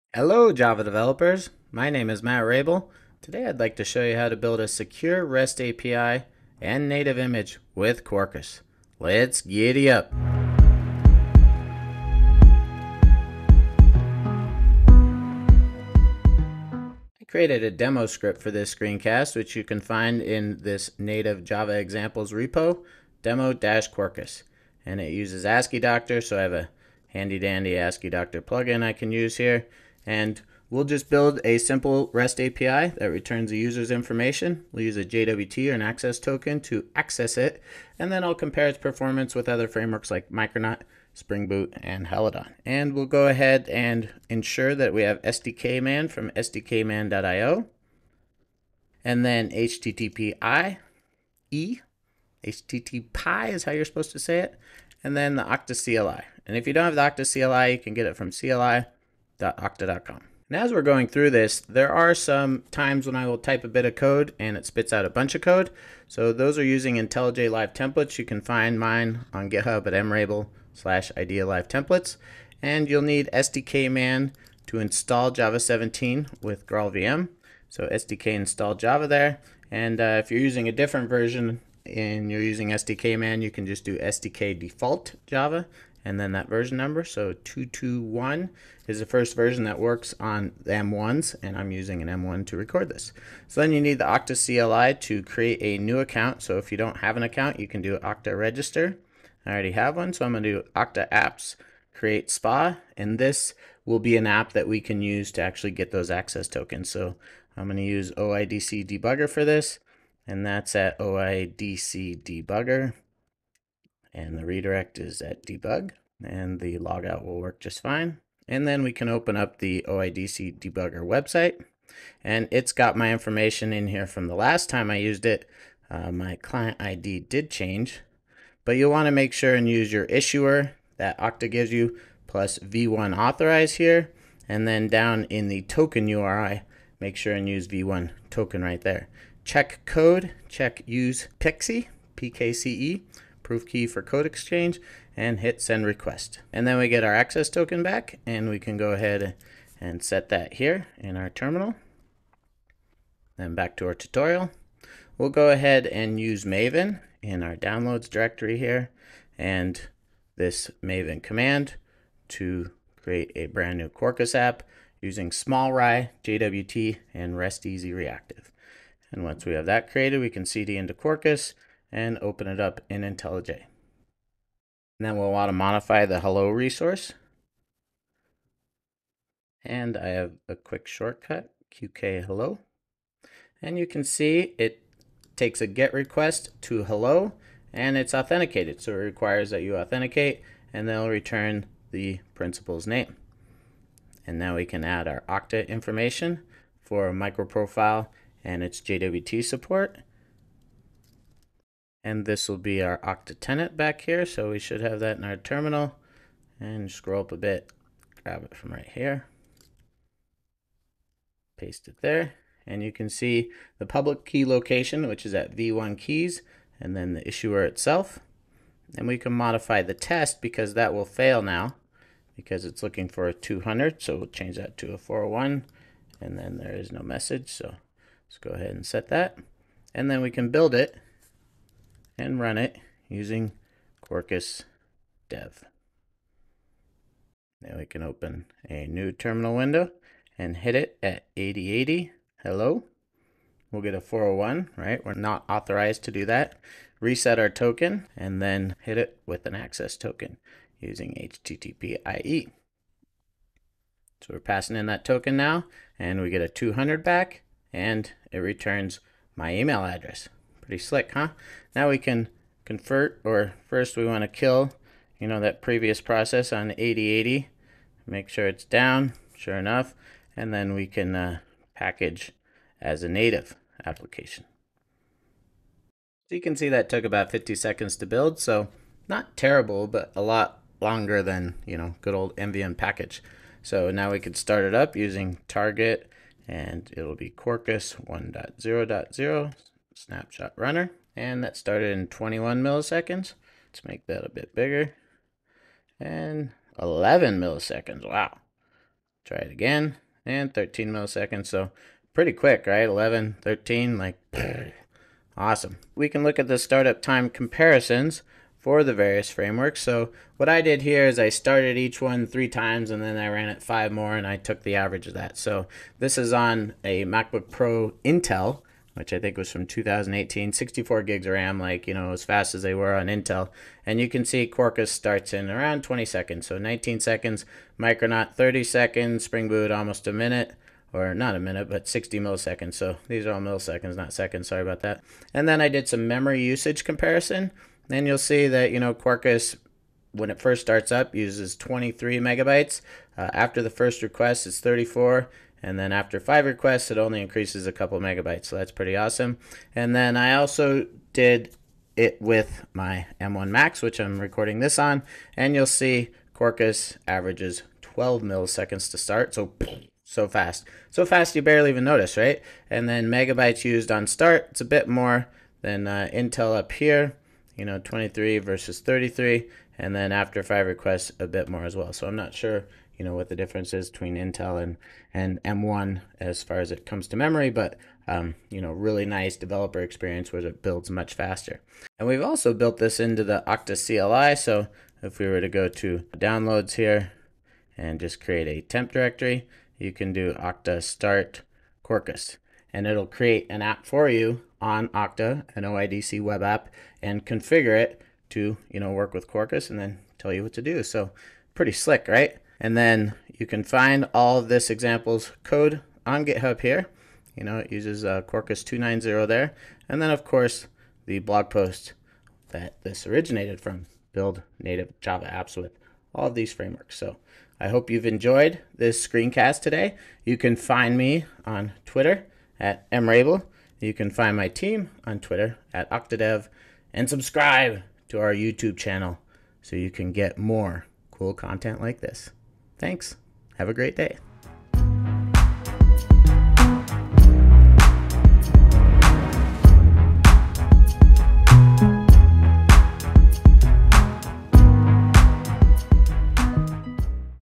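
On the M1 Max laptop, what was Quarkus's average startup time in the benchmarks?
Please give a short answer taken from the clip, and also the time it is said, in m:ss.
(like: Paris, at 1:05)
12 milliseconds, at 5:57.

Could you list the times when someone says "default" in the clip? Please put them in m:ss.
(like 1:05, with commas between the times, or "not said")
1:24.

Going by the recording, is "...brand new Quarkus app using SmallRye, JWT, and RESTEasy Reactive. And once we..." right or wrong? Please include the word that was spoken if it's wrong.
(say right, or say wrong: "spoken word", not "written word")
right.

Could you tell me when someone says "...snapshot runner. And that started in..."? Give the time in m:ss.
4:50.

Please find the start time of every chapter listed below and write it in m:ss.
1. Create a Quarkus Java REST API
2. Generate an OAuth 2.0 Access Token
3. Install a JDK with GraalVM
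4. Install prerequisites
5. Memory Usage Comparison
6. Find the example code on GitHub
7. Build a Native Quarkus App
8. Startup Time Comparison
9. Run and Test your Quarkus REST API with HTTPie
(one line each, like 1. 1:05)
1. 2:35
2. 1:33
3. 1:12
4. 0:43
5. 5:35
6. 6:43
7. 4:30
8. 5:06
9. 3:51.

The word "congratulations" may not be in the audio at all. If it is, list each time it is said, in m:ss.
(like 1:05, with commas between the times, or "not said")
not said.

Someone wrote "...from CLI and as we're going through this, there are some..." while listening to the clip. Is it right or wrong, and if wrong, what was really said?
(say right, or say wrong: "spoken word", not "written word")
right.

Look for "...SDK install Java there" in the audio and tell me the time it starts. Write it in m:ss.
1:17.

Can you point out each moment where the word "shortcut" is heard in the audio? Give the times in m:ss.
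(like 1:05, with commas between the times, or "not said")
3:00.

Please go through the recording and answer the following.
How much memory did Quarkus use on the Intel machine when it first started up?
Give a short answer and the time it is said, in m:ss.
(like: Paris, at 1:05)
23 megabytes, at 5:41.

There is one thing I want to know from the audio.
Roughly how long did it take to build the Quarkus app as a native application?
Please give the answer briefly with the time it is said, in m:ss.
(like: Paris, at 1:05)
50 seconds, at 4:37.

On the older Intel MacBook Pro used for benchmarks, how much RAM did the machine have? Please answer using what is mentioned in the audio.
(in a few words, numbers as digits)
64 GB.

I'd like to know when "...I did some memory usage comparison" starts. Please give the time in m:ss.
5:35.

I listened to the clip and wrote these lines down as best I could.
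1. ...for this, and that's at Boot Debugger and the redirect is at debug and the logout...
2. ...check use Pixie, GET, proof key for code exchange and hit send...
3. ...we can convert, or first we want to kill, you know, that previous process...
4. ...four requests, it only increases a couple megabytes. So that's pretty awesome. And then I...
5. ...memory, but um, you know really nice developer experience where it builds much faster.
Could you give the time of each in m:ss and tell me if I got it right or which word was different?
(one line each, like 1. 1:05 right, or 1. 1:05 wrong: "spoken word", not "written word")
1. 1:49 wrong: "OIDC", not "Boot"
2. 2:20 wrong: "PKCE", not "GET"
3. 4:21 right
4. 5:46 wrong: "five", not "four"
5. 6:17 right.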